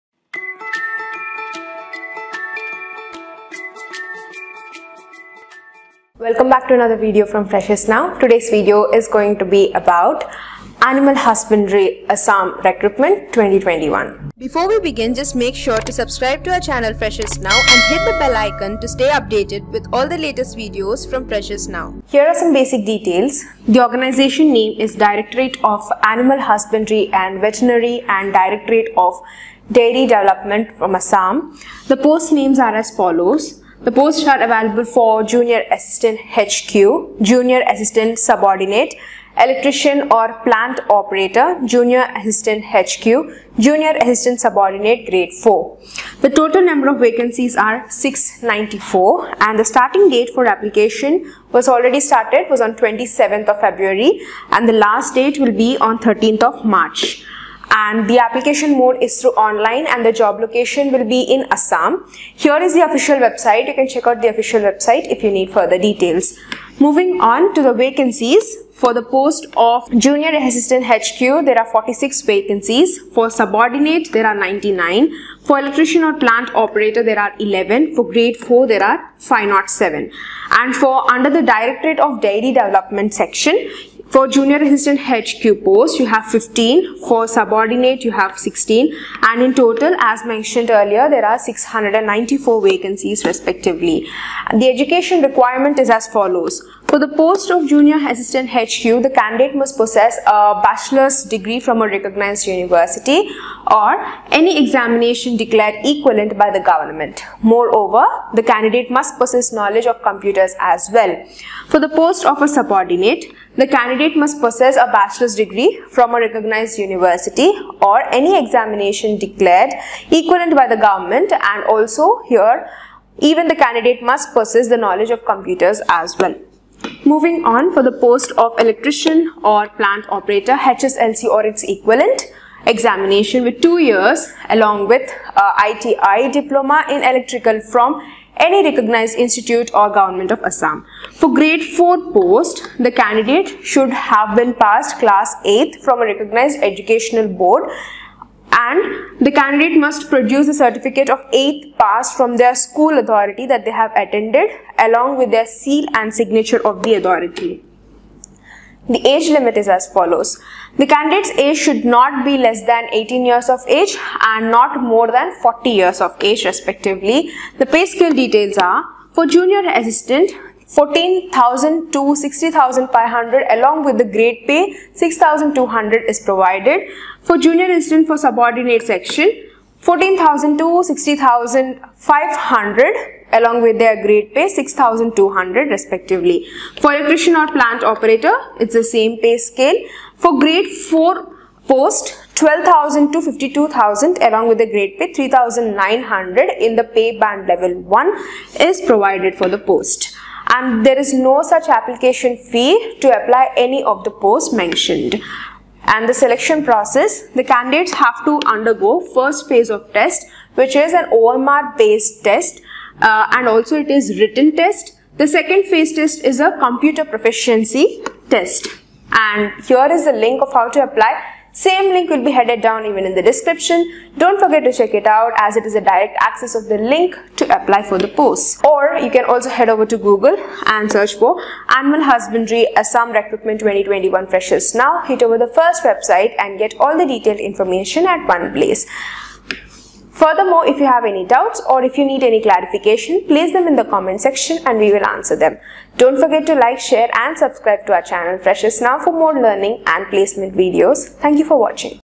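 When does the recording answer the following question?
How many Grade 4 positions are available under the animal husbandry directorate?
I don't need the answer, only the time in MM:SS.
01:19.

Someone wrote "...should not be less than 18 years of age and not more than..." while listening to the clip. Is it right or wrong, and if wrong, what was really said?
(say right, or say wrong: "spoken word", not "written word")
right.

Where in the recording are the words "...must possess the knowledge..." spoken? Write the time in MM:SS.
02:04.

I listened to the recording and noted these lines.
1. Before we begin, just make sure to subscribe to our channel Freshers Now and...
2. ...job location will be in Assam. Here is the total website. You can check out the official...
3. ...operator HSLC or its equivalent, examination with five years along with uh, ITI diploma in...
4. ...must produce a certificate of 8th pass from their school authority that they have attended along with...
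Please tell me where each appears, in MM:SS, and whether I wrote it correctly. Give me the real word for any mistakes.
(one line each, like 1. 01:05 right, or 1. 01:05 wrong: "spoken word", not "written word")
1. 00:14 right
2. 01:00 wrong: "official", not "total"
3. 02:10 wrong: "two", not "five"
4. 02:29 right.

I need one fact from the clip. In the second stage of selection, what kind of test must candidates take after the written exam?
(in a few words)
Computer proficiency test.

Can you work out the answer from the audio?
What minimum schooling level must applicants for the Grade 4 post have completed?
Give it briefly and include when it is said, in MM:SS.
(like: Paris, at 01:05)
Class 8, at 02:24.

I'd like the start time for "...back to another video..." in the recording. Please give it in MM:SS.
00:06.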